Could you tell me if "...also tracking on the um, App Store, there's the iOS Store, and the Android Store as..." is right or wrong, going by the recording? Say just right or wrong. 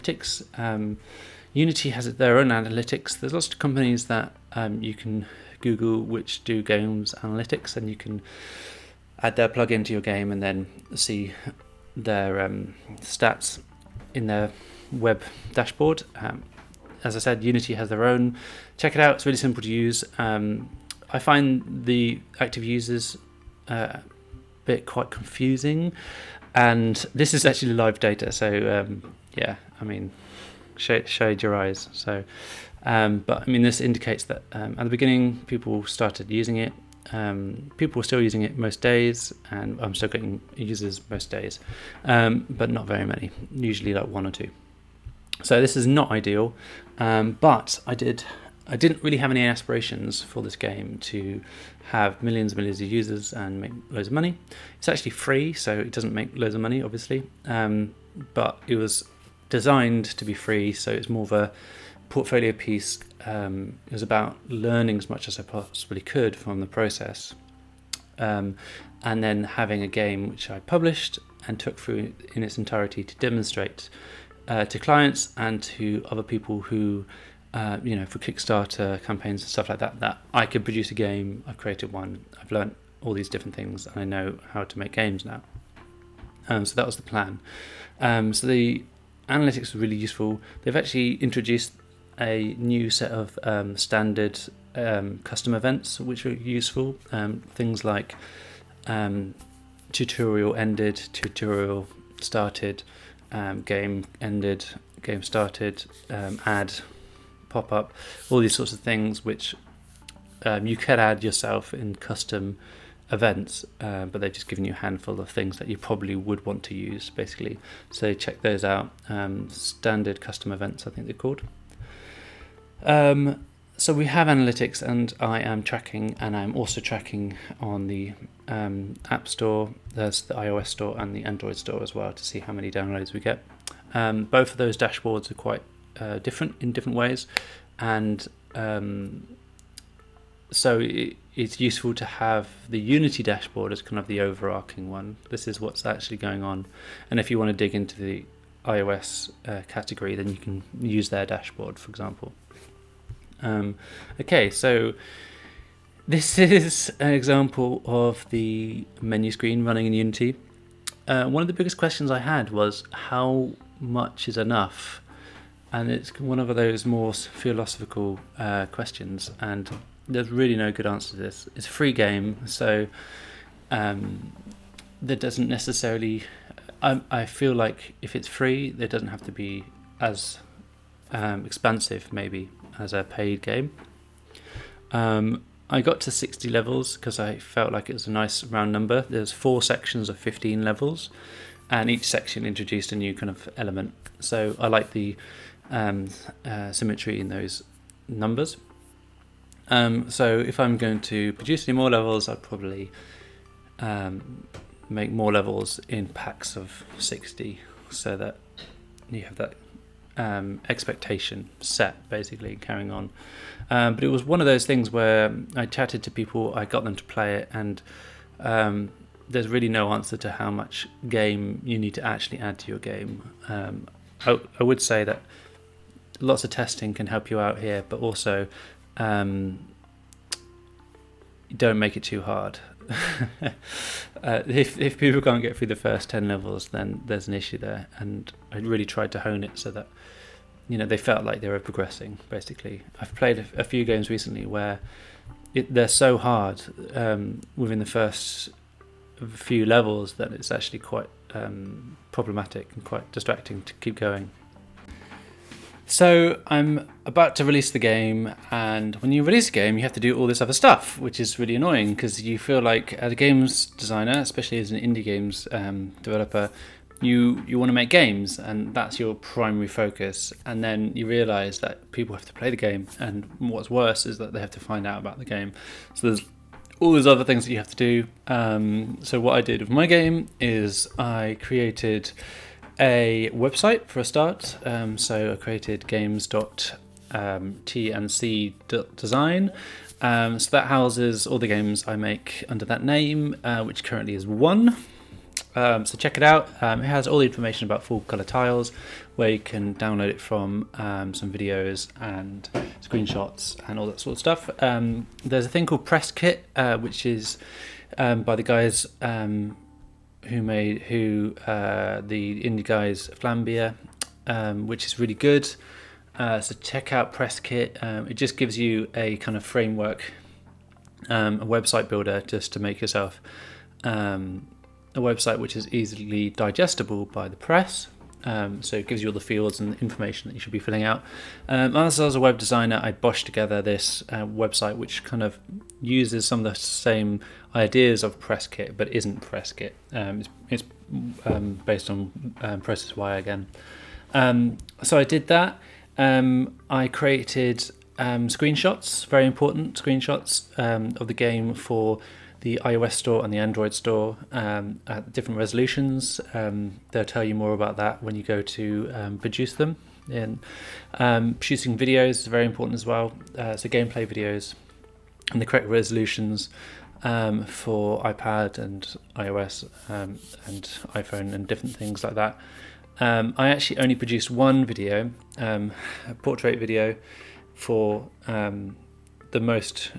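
right.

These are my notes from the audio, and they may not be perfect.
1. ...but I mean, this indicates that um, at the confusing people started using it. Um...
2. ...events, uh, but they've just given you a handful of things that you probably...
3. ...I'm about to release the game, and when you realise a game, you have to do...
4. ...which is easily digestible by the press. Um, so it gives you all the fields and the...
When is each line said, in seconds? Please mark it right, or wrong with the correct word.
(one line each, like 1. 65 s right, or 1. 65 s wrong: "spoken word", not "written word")
1. 33 s wrong: "beginning", not "confusing"
2. 113 s right
3. 256 s wrong: "release", not "realise"
4. 325 s right.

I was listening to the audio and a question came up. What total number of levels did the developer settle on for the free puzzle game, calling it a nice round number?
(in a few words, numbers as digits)
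60.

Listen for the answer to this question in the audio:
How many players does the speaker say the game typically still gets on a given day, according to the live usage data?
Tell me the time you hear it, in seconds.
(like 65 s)
44 s.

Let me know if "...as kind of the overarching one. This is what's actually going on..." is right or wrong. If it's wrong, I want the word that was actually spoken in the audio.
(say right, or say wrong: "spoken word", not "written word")
right.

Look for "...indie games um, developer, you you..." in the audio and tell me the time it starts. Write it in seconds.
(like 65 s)
264 s.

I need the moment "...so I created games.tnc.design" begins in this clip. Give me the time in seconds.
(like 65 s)
284 s.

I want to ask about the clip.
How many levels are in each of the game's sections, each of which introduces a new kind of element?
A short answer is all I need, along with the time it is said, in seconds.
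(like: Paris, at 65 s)
15, at 190 s.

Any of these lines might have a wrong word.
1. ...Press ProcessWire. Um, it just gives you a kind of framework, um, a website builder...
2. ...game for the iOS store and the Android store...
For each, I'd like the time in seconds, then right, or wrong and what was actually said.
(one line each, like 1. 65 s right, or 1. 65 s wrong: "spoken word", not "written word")
1. 317 s wrong: "Kit", not "ProcessWire"
2. 351 s right.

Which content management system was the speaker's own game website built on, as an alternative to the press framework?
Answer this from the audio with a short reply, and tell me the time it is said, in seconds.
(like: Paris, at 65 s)
ProcessWire, at 342 s.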